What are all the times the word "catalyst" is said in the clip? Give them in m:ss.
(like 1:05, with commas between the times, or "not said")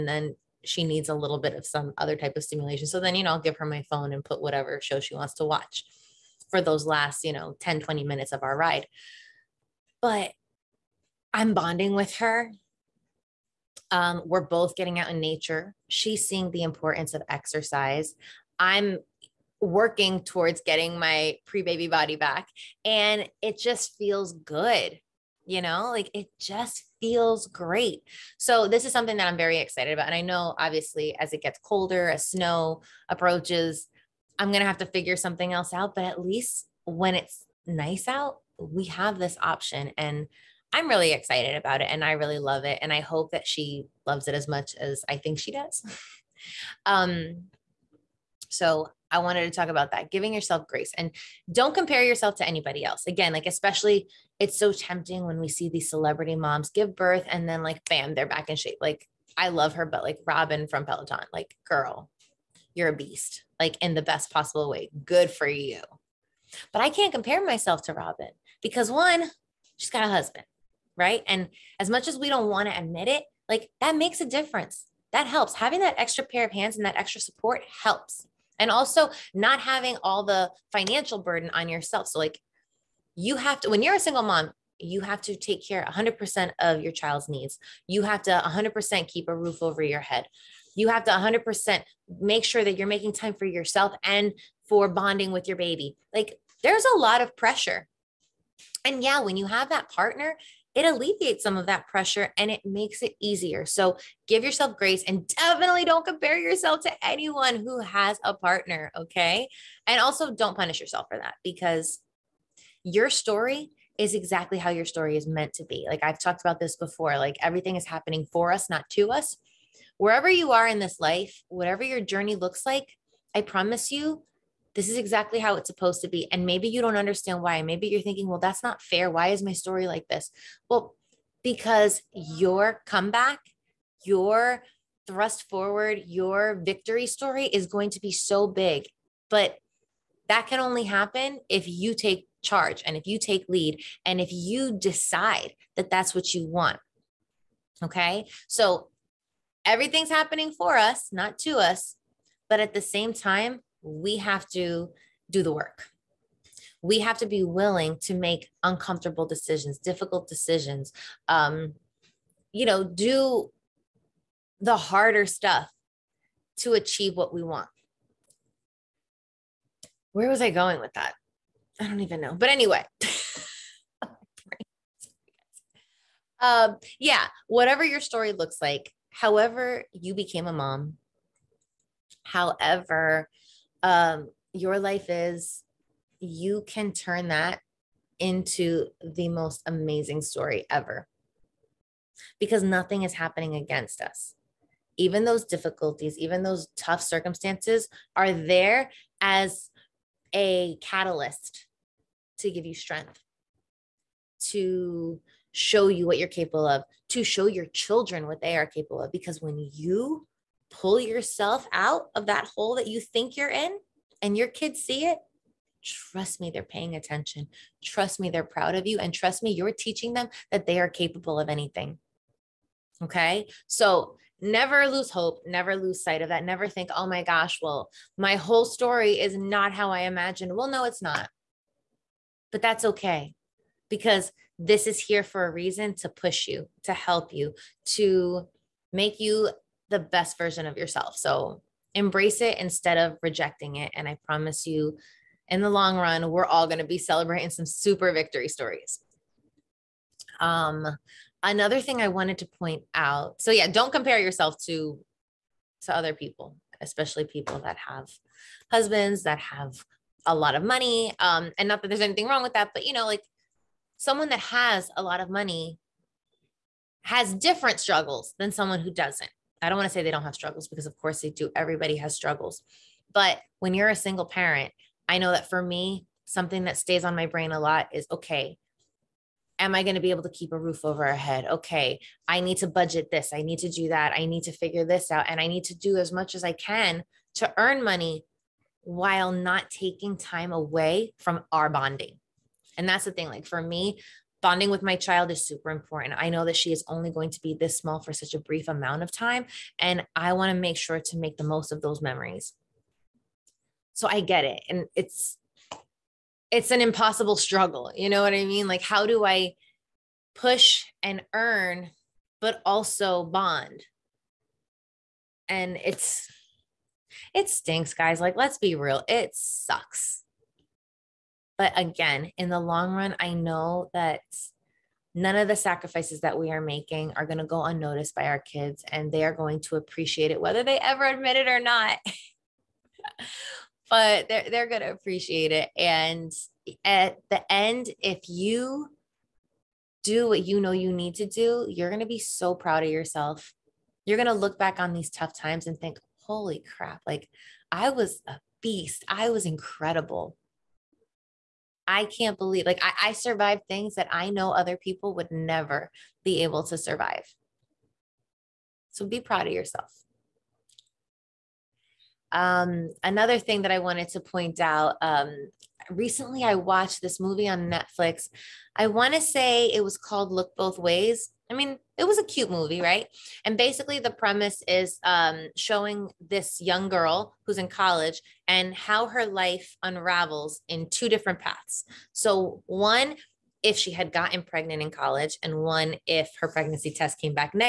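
3:20.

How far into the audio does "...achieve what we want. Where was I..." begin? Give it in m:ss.
2:46.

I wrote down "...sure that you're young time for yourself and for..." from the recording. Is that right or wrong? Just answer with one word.
wrong.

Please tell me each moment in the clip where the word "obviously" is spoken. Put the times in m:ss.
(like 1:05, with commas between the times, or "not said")
0:30.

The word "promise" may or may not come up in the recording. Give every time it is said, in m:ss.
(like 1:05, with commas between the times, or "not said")
2:03, 4:04.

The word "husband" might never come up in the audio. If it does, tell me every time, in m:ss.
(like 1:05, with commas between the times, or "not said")
1:10, 4:18.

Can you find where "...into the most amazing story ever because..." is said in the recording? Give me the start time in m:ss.
3:08.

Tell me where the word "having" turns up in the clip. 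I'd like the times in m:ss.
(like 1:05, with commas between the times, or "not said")
1:15, 1:19.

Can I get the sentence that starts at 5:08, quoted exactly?
Like, how do I push and earn, but also bond?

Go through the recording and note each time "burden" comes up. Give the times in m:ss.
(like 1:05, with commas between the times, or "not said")
1:21.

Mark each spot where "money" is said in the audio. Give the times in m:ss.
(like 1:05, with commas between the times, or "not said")
4:20, 4:25, 4:47.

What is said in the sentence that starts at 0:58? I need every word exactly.
Like, I love her, but like Robin from Peloton, like, girl, you're a beast, like, in the best possible way.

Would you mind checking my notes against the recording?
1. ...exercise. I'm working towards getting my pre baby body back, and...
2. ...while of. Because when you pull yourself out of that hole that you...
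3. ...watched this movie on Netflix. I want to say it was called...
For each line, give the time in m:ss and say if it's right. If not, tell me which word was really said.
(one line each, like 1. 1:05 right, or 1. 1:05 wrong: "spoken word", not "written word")
1. 0:17 right
2. 3:28 wrong: "capable", not "while"
3. 6:06 right.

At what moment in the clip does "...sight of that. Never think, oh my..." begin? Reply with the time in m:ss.
3:46.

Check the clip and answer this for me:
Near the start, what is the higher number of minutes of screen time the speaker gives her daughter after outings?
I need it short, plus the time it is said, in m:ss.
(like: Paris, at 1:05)
20 minutes, at 0:07.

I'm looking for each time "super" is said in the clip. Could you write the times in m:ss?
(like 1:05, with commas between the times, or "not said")
4:07, 4:55.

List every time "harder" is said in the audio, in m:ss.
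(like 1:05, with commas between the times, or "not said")
2:44.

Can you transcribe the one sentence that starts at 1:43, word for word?
So give yourself grace and definitely don't compare yourself to anyone who has a partner.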